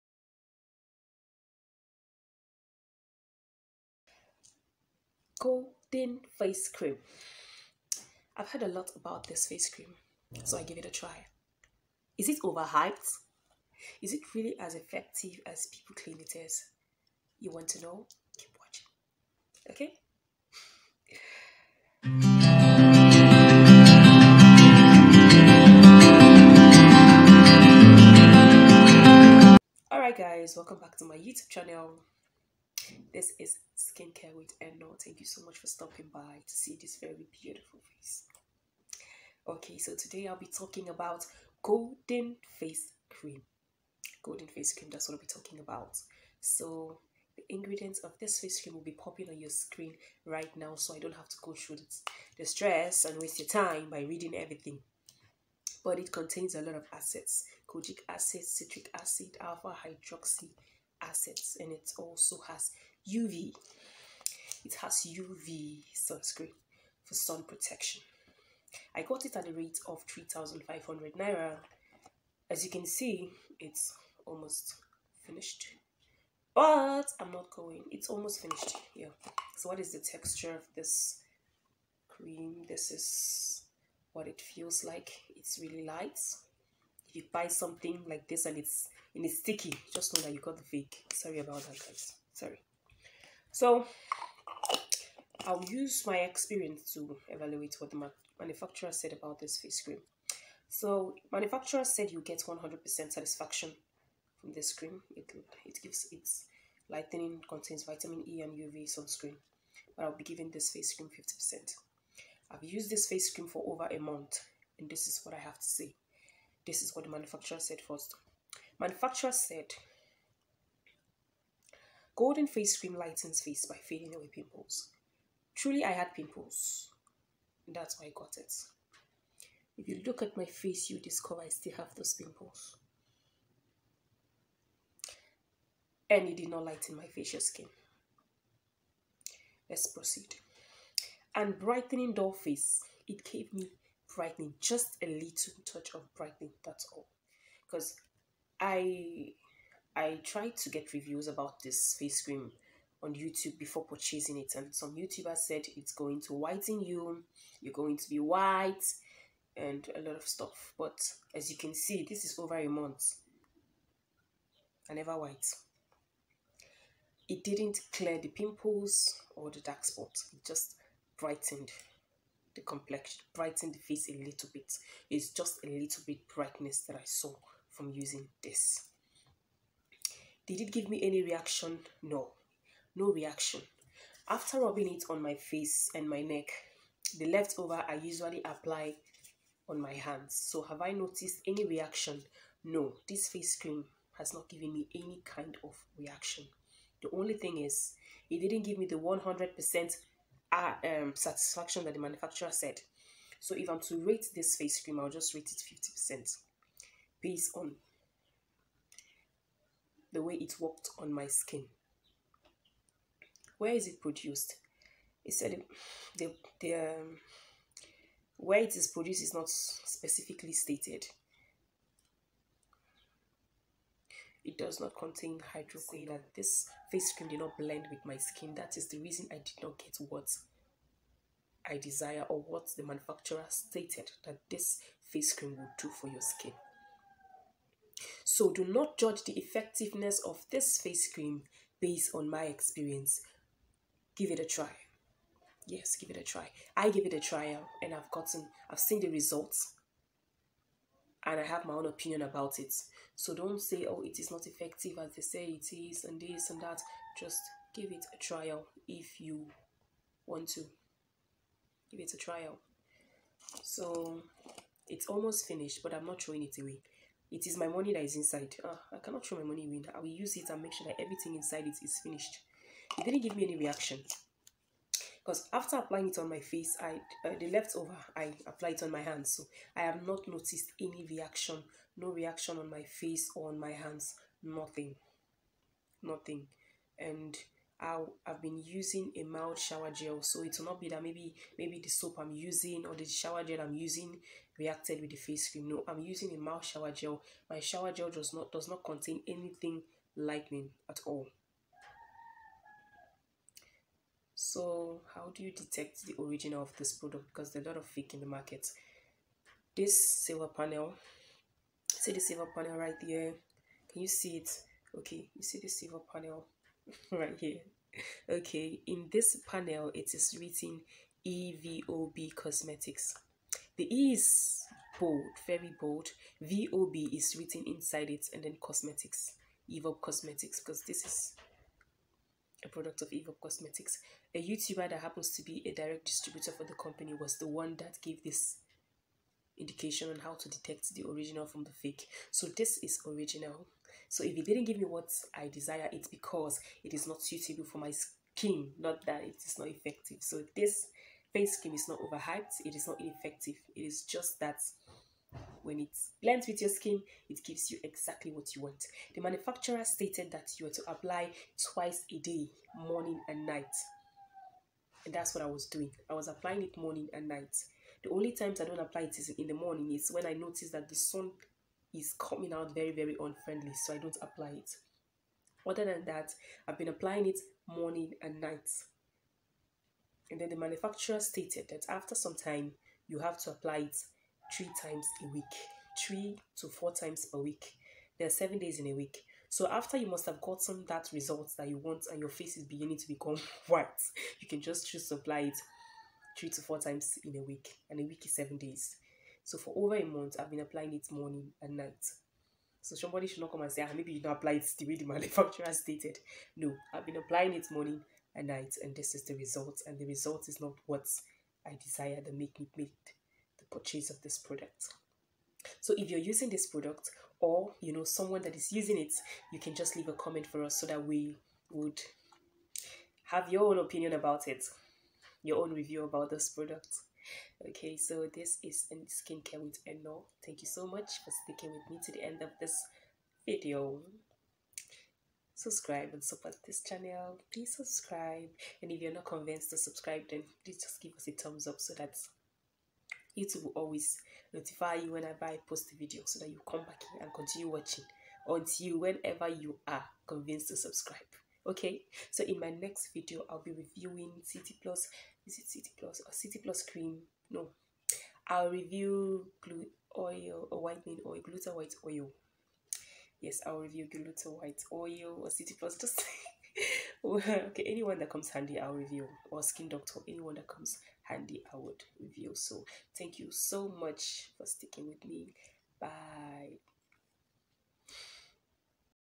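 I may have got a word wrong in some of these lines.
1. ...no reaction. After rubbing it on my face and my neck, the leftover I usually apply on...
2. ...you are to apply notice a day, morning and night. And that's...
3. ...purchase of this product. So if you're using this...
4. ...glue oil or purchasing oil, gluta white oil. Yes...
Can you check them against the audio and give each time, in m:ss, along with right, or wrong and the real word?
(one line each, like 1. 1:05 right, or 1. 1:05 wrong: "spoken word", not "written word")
1. 3:02 right
2. 6:00 wrong: "twice", not "notice"
3. 6:53 right
4. 7:39 wrong: "whitening", not "purchasing".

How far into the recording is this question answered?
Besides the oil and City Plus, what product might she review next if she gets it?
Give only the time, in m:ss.
7:49.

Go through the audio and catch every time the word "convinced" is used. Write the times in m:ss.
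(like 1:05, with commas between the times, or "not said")
7:19, 7:30.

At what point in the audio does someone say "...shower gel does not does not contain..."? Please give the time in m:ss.
4:57.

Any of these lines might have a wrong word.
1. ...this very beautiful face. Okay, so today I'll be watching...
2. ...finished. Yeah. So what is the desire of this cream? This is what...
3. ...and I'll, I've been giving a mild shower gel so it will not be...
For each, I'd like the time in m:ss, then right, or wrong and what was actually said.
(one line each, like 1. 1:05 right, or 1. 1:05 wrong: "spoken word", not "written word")
1. 0:36 wrong: "talking", not "watching"
2. 1:18 wrong: "texture", not "desire"
3. 4:46 wrong: "using", not "giving".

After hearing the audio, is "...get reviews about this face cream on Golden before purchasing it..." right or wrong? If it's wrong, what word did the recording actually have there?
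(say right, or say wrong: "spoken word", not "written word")
wrong: "YouTube", not "Golden".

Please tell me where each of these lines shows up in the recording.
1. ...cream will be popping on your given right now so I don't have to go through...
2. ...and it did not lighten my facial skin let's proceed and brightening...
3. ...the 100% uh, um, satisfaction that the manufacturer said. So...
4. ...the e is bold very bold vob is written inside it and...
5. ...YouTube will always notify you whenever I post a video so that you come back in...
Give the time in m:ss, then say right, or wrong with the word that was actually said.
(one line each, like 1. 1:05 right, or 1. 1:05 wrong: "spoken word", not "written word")
1. 0:48 wrong: "screen", not "given"
2. 2:16 right
3. 3:18 right
4. 5:23 right
5. 7:23 right.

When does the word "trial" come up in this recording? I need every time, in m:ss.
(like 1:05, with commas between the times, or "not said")
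4:18, 4:22.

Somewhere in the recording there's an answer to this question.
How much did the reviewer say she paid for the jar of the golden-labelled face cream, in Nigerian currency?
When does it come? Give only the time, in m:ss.
1:10.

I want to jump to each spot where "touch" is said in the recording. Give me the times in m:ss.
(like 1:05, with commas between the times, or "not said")
2:25.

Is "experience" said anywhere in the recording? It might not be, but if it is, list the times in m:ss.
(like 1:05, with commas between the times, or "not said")
1:36, 4:02.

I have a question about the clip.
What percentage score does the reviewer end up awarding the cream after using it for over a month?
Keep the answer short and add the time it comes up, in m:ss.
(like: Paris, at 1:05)
50%, at 1:51.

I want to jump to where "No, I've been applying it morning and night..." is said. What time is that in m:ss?
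6:46.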